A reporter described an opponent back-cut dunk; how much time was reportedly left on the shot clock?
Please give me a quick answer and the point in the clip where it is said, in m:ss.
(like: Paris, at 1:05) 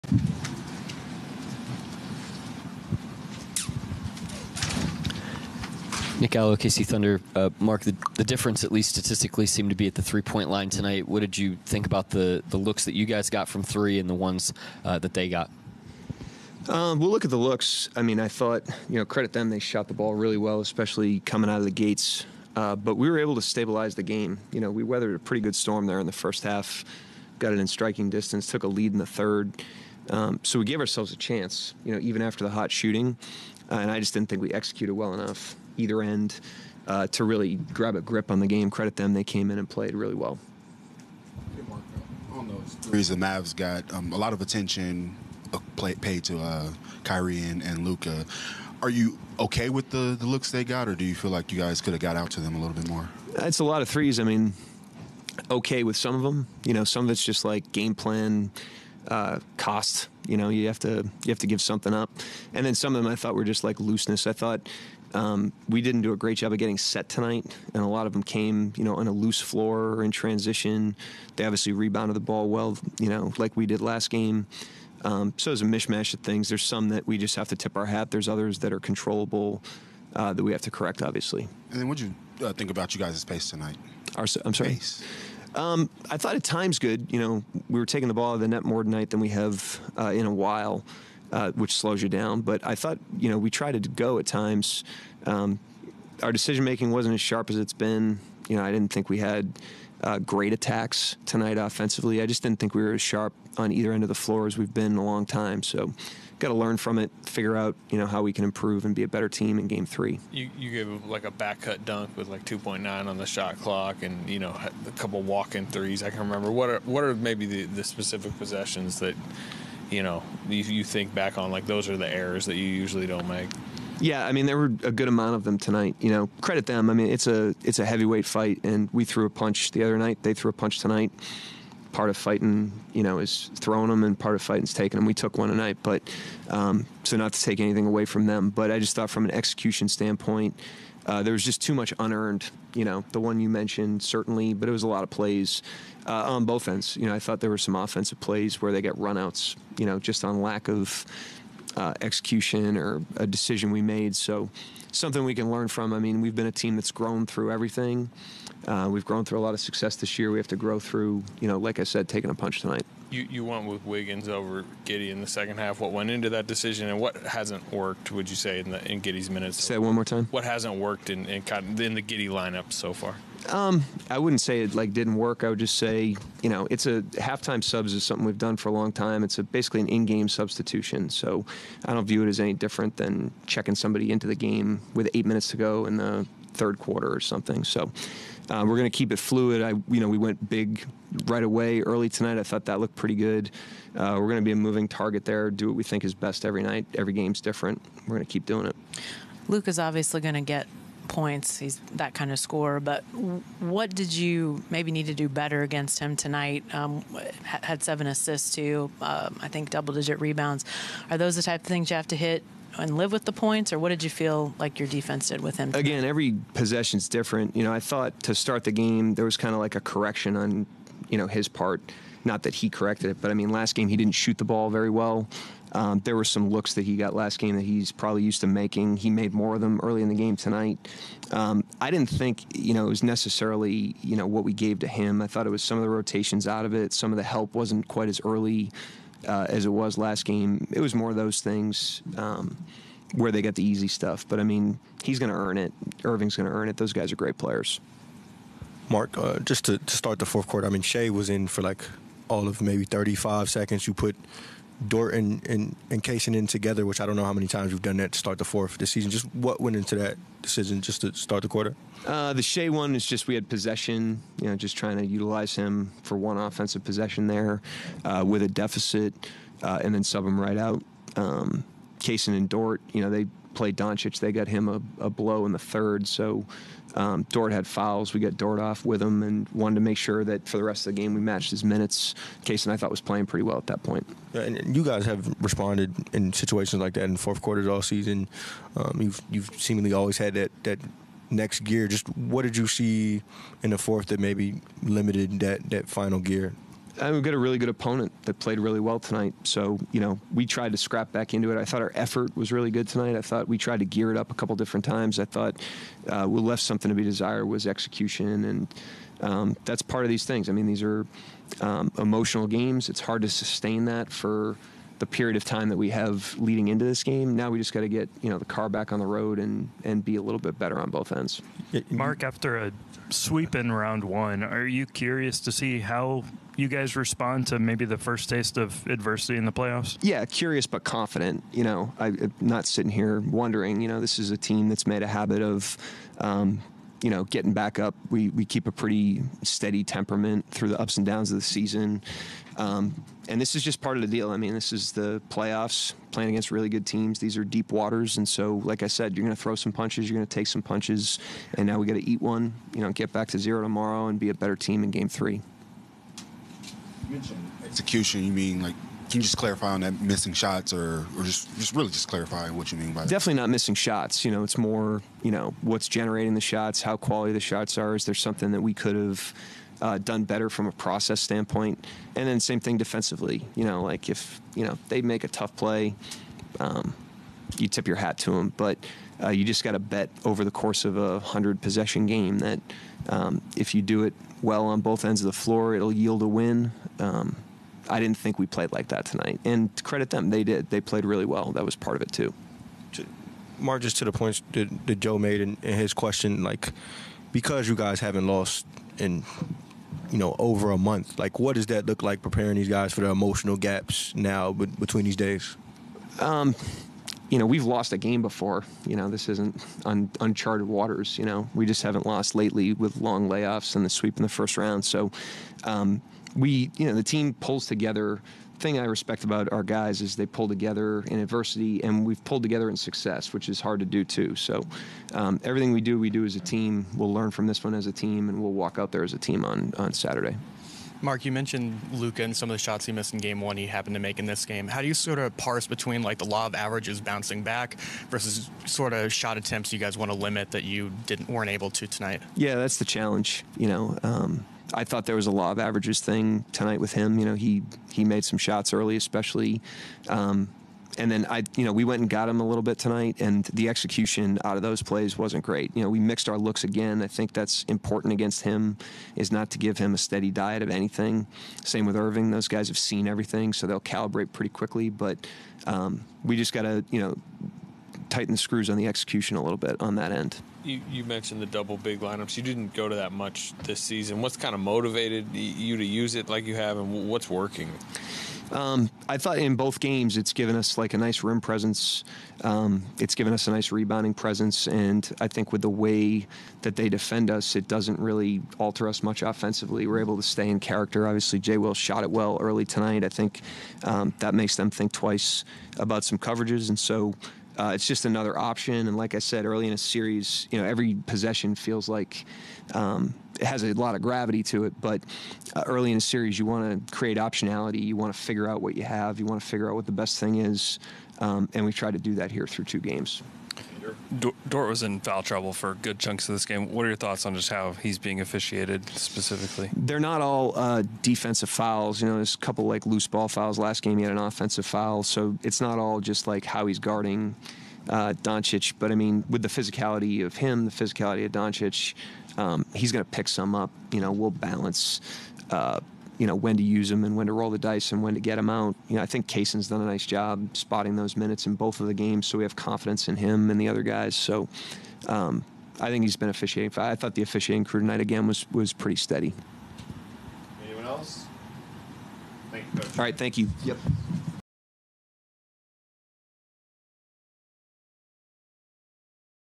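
2.9, at 1:52.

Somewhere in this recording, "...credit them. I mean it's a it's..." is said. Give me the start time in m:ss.
2:06.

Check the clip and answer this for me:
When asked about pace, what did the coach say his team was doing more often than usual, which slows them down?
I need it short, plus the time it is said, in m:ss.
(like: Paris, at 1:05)
taking the ball out of the net, at 1:27.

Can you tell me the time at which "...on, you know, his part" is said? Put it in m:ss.
3:40.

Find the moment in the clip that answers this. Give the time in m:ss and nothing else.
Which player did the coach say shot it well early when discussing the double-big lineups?
8:11.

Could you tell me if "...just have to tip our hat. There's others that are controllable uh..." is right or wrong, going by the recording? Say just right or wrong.
right.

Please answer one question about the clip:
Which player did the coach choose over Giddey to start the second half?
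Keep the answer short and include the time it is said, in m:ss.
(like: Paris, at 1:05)
Wiggins, at 2:43.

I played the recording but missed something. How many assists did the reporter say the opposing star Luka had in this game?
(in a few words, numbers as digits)
7.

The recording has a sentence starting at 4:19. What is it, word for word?
Just what went into that decision just to start the quarter?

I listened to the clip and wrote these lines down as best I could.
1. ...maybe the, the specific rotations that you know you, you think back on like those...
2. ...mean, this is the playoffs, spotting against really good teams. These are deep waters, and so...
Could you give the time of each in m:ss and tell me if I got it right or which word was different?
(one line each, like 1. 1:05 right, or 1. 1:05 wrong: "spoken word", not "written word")
1. 1:57 wrong: "possessions", not "rotations"
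2. 5:44 wrong: "playing", not "spotting".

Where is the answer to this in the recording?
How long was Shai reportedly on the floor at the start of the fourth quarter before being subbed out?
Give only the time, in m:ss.
4:12.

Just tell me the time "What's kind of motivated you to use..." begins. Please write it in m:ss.
7:54.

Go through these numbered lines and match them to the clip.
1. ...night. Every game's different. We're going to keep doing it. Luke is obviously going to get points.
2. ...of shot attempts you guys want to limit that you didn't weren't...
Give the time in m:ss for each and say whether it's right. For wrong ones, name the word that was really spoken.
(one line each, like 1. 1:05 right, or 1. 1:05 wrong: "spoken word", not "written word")
1. 3:16 right
2. 7:18 right.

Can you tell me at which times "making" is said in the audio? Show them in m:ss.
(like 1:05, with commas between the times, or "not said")
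1:36, 3:48.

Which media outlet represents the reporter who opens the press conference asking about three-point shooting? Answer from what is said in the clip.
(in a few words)
KC Thunder.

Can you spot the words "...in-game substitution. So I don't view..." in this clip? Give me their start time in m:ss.
2:59.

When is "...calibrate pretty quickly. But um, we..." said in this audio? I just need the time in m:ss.
7:43.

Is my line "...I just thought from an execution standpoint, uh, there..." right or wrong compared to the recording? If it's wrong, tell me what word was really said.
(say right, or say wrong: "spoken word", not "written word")
right.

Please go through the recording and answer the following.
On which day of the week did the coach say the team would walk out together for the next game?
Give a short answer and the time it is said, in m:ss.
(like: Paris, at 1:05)
Saturday, at 7:09.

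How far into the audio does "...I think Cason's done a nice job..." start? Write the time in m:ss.
8:59.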